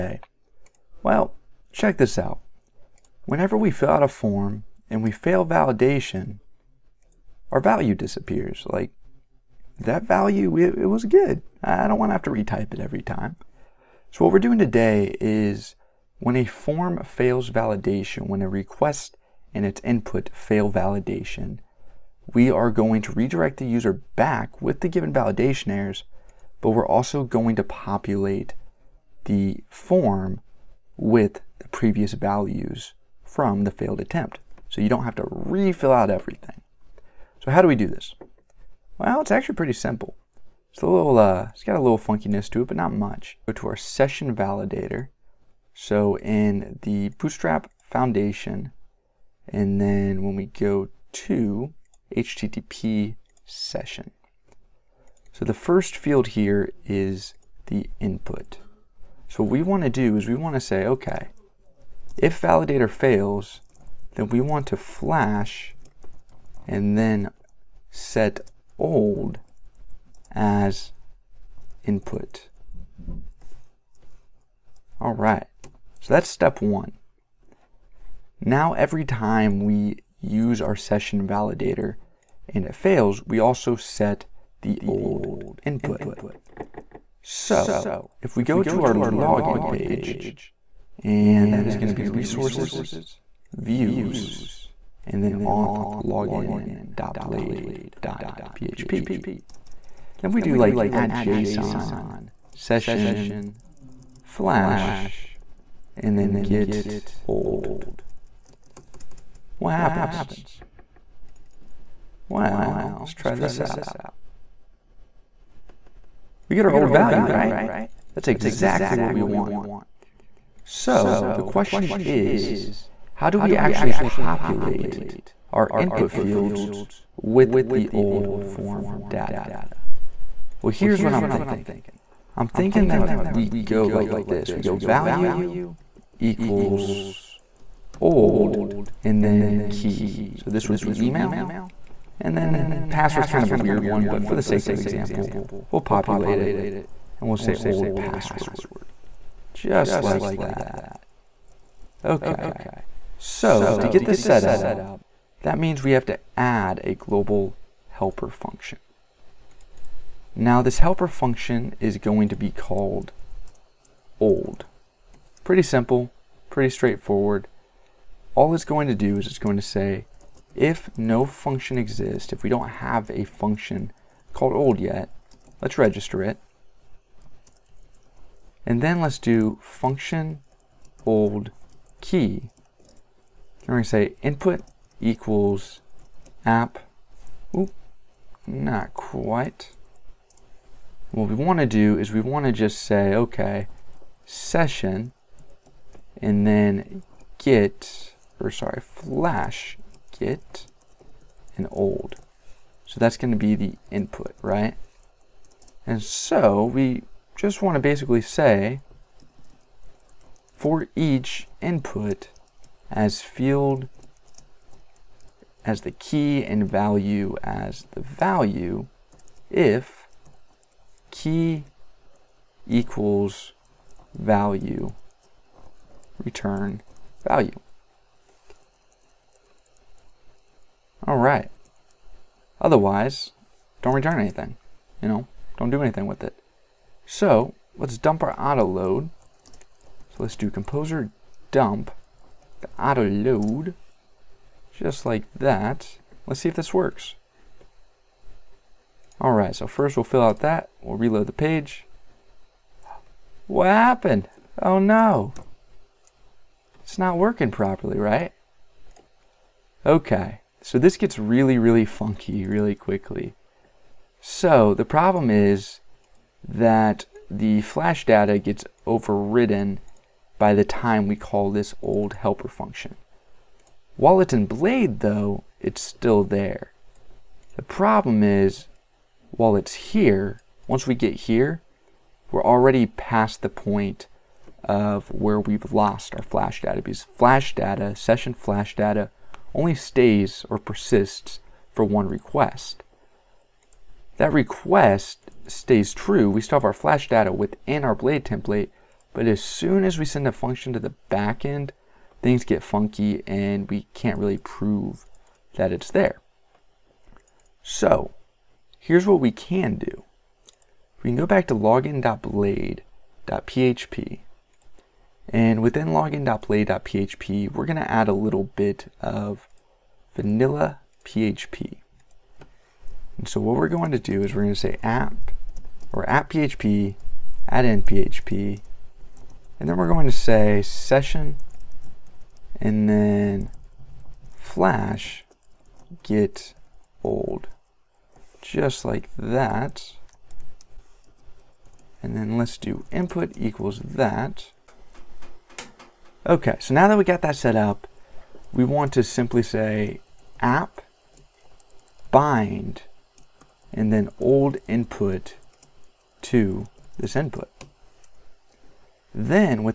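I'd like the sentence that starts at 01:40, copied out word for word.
Then we do like add JSON session flash and then get old.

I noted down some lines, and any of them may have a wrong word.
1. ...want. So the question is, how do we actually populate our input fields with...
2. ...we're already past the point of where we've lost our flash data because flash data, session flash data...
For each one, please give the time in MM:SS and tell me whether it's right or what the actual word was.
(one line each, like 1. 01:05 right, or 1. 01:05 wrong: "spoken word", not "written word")
1. 01:59 right
2. 04:42 right.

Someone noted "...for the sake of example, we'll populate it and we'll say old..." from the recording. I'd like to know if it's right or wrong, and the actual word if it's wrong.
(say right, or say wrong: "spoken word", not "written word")
right.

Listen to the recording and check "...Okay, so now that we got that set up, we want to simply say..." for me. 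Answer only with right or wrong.
right.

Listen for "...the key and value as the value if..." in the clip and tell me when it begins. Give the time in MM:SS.
03:35.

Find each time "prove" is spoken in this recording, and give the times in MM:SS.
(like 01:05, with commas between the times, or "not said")
05:04.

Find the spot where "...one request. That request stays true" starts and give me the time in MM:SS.
04:51.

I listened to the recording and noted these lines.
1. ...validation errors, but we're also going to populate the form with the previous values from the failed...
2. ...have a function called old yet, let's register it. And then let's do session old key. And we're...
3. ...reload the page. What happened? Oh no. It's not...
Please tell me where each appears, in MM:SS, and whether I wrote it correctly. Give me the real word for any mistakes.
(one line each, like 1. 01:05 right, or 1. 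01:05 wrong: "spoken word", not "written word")
1. 00:25 right
2. 02:52 wrong: "function", not "session"
3. 04:10 right.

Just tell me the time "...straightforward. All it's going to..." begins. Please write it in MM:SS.
02:46.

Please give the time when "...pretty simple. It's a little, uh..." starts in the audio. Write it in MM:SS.
00:39.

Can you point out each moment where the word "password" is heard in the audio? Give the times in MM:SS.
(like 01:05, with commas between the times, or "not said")
02:22, 02:27.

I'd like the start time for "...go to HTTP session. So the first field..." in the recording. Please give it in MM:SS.
00:50.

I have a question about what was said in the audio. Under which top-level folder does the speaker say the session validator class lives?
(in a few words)
Bootstrap Foundation.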